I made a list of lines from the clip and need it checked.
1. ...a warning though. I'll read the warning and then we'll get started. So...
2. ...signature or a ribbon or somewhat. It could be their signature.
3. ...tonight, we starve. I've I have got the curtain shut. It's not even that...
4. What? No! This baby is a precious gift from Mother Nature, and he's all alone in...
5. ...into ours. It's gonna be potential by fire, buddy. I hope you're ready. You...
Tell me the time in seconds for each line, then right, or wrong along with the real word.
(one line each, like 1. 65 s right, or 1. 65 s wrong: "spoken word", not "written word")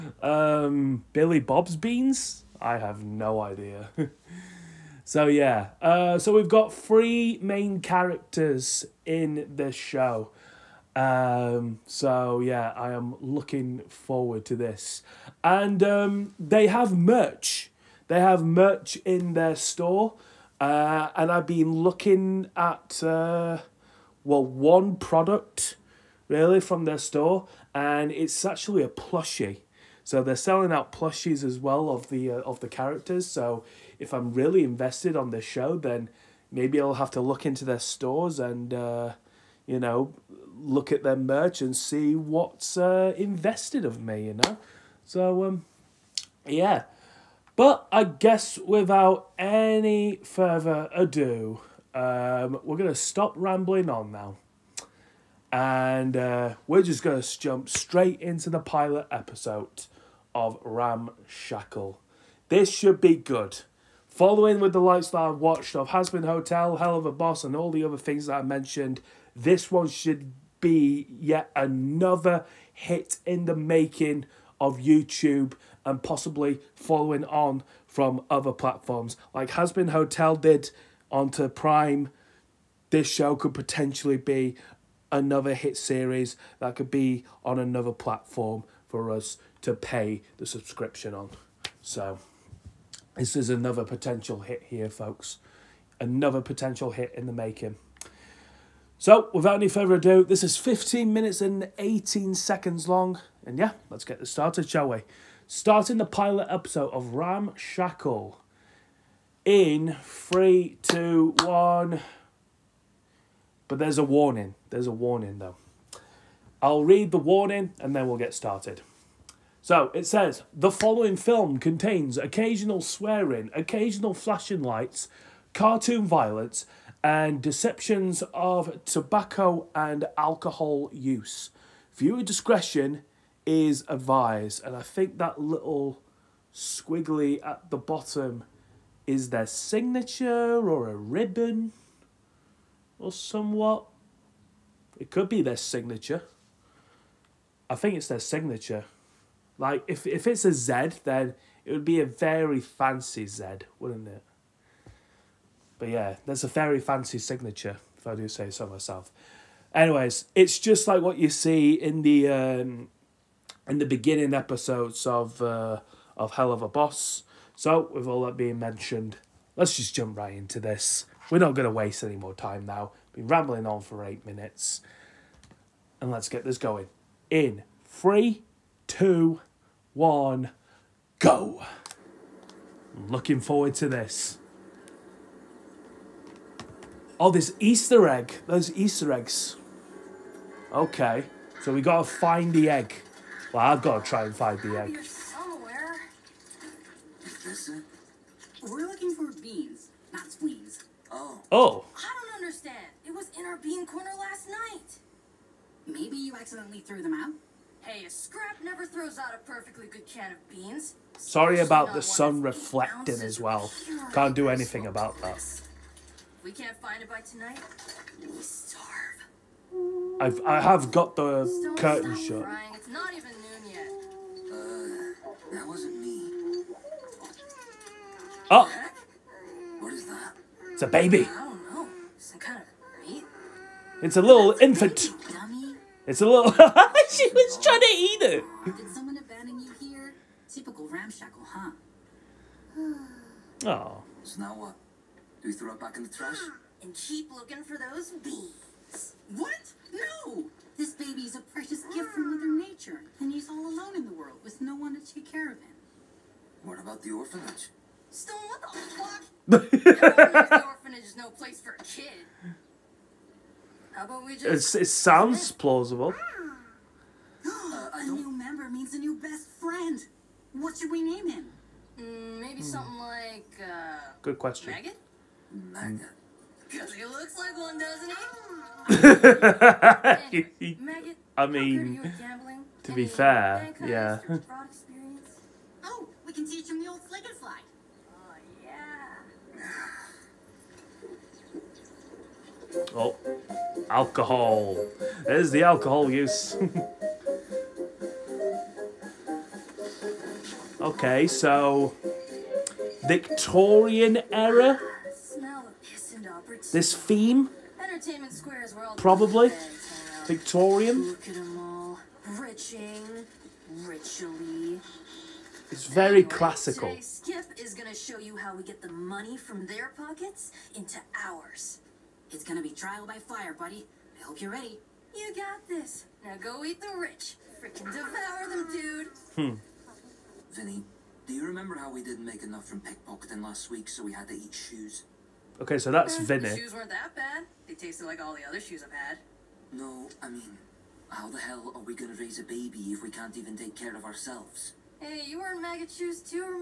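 1. 114 s right
2. 139 s right
3. 217 s right
4. 249 s right
5. 320 s wrong: "trial", not "potential".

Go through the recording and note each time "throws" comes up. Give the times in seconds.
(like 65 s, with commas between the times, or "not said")
208 s, 245 s.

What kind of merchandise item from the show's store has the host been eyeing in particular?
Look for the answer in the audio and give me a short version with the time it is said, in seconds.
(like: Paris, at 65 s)
Plushie, at 28 s.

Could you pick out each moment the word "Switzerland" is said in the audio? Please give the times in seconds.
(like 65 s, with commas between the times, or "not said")
not said.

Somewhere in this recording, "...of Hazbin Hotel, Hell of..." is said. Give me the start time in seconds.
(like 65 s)
65 s.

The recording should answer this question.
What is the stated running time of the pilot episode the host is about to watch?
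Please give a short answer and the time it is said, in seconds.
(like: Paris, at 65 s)
15 minutes and 18 seconds, at 100 s.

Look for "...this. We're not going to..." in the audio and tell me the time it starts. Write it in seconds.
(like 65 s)
170 s.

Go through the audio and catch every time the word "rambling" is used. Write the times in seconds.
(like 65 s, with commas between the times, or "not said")
53 s, 173 s.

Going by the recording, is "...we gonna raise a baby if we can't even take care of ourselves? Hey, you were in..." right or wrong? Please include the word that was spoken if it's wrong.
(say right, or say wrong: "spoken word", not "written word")
right.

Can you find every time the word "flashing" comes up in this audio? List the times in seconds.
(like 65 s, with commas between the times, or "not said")
124 s.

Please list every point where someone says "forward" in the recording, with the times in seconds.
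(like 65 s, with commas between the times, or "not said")
13 s, 183 s.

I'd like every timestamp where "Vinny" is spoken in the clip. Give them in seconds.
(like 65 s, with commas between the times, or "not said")
330 s, 336 s.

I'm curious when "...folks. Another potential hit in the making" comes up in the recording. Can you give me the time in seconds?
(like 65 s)
94 s.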